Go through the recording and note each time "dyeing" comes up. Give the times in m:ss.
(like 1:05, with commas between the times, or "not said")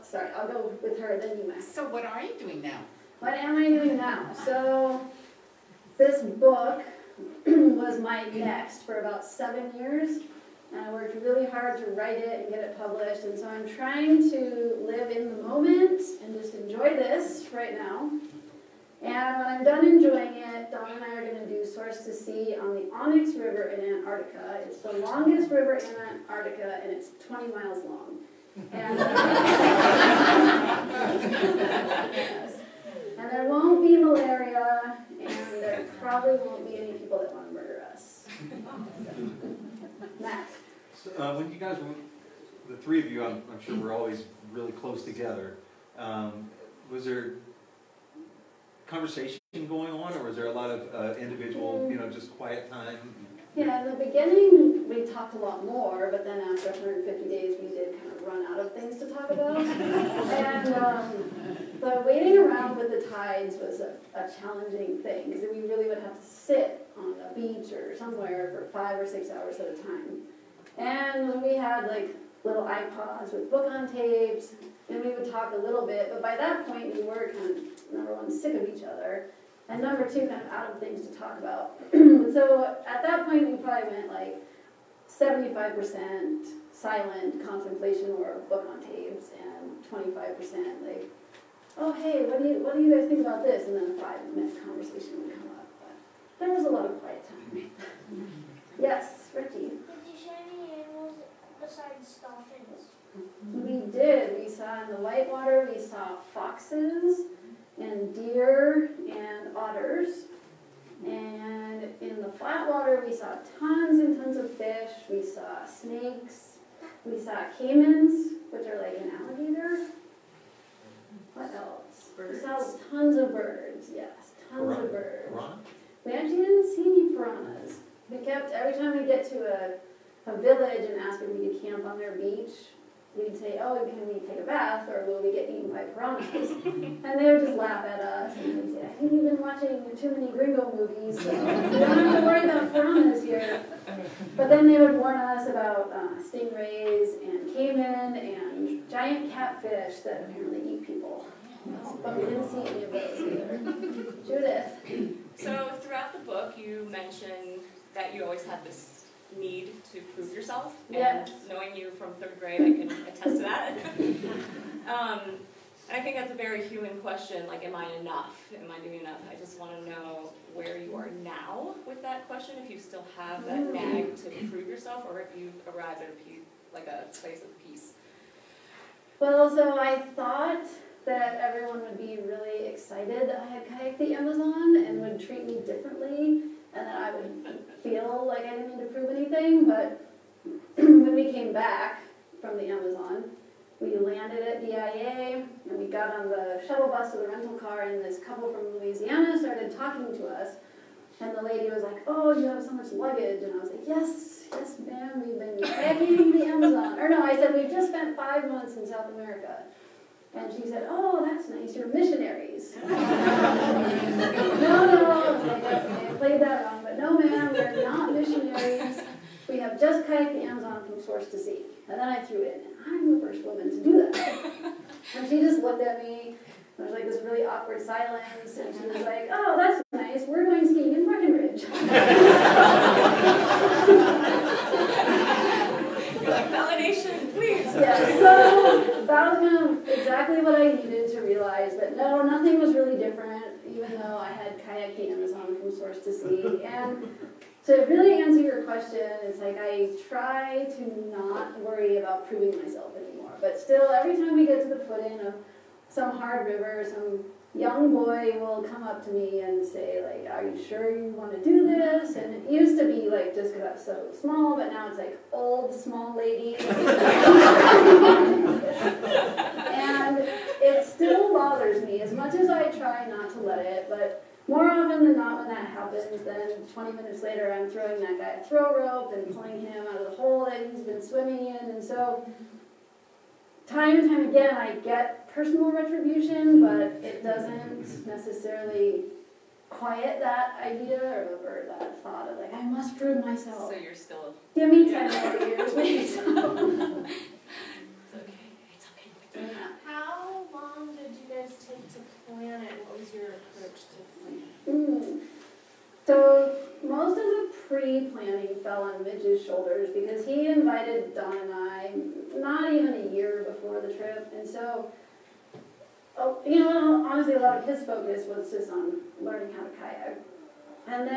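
not said.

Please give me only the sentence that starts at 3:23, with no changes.
And I was like, Yes, yes, ma'am, we've been in the Amazon.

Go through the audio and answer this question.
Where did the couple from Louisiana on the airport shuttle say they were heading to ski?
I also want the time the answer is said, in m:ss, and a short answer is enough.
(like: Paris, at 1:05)
Breckenridge, at 3:51.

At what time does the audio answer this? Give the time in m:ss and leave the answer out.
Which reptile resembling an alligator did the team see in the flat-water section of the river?
1:57.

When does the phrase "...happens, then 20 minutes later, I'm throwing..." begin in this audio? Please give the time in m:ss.
4:35.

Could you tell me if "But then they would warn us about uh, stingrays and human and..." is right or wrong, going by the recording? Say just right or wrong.
wrong.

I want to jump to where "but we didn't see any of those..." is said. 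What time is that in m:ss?
2:32.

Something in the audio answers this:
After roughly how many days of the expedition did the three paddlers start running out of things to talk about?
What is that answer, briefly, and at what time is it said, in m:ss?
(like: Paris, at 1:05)
150, at 0:56.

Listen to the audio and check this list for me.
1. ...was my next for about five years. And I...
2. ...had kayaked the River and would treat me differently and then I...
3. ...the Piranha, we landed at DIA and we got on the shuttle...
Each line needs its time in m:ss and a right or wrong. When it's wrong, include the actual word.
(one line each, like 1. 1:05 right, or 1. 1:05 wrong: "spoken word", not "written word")
1. 0:07 wrong: "seven", not "five"
2. 3:03 wrong: "Amazon", not "River"
3. 3:12 wrong: "Amazon", not "Piranha".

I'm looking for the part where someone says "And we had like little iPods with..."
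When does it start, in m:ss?
1:10.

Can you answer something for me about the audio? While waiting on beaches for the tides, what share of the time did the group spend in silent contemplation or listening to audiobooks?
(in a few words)
75%.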